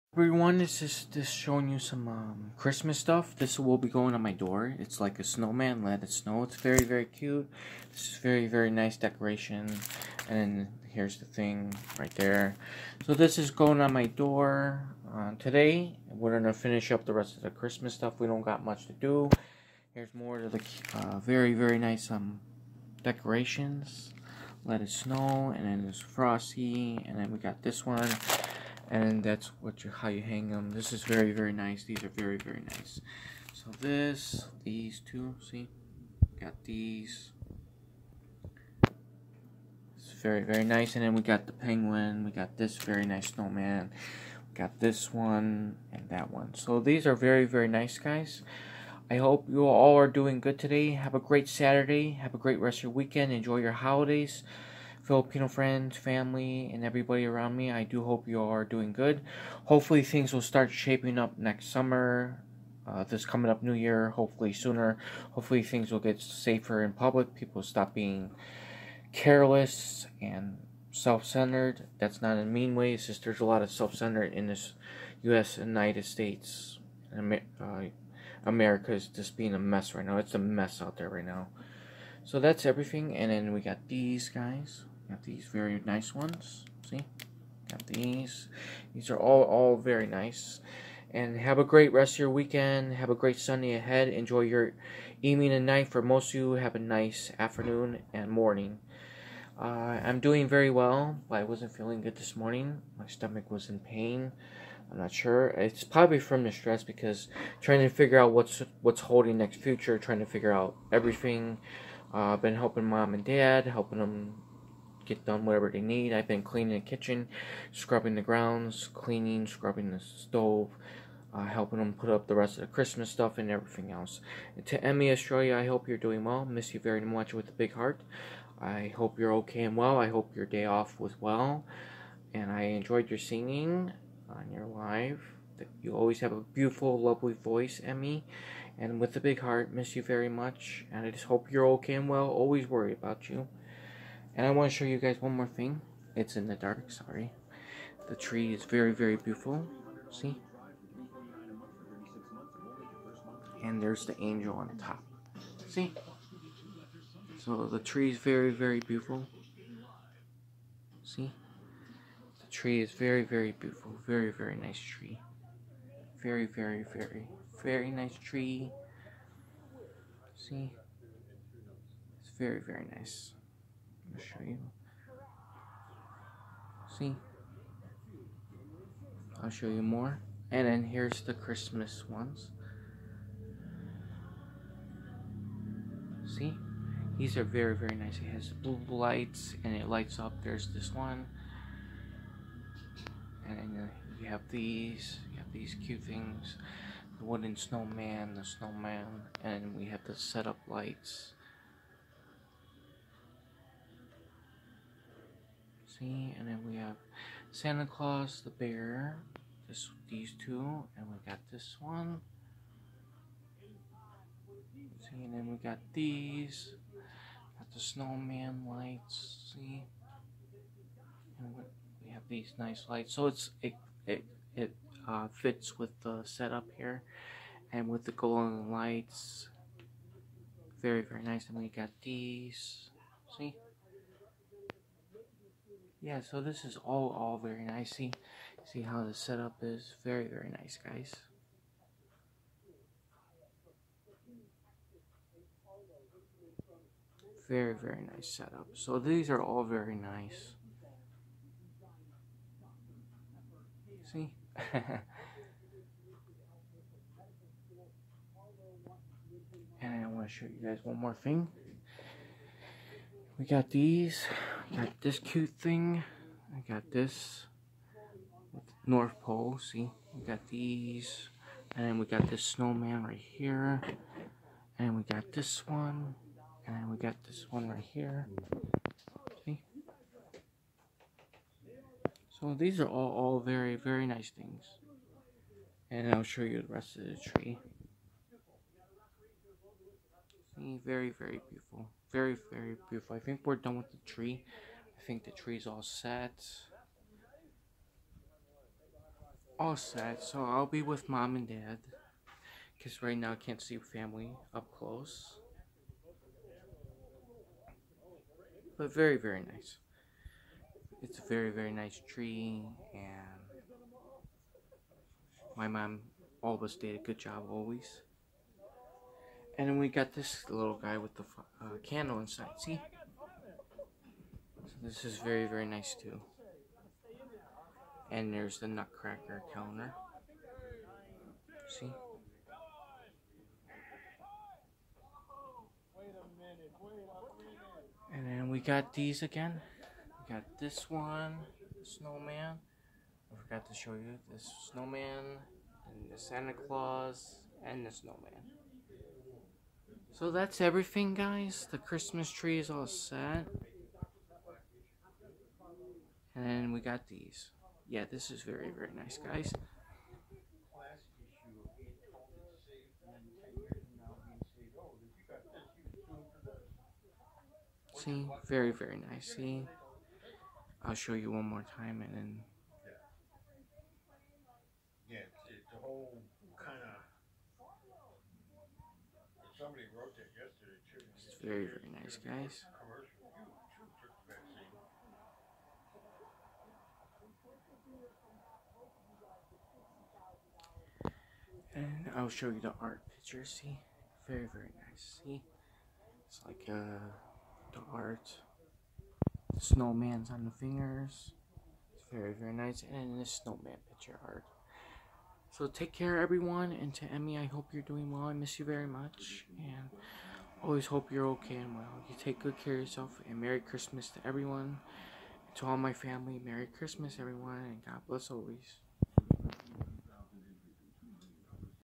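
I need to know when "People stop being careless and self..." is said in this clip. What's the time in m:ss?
1:07.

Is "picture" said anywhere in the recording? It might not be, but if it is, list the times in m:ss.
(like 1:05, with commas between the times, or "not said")
6:33, 6:43.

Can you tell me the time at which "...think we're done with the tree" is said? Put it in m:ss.
4:53.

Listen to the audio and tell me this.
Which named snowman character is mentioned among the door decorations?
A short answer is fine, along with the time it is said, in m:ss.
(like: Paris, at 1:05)
Frosty, at 0:26.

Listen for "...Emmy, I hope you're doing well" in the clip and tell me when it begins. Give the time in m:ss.
6:47.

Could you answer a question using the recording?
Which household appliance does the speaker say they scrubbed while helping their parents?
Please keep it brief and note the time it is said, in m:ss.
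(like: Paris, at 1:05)
Stove, at 1:59.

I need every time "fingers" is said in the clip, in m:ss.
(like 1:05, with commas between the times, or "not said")
6:40.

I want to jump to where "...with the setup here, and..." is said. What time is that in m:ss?
3:45.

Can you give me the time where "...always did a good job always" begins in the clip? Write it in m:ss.
5:16.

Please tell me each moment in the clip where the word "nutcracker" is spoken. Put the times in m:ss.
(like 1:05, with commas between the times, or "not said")
5:28.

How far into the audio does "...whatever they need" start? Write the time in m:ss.
1:55.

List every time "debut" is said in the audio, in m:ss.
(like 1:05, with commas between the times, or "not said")
not said.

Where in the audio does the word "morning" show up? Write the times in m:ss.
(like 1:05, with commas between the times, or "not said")
1:38, 1:42.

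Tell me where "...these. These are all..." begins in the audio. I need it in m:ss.
1:27.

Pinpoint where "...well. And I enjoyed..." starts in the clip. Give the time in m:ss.
2:11.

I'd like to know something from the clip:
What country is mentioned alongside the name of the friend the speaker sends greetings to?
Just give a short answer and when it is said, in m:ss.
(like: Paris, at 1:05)
Australia, at 2:05.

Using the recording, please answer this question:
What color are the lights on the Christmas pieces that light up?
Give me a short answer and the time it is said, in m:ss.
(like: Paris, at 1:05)
Blue, at 3:08.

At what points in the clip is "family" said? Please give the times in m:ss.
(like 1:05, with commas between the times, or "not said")
0:55, 5:03, 6:55.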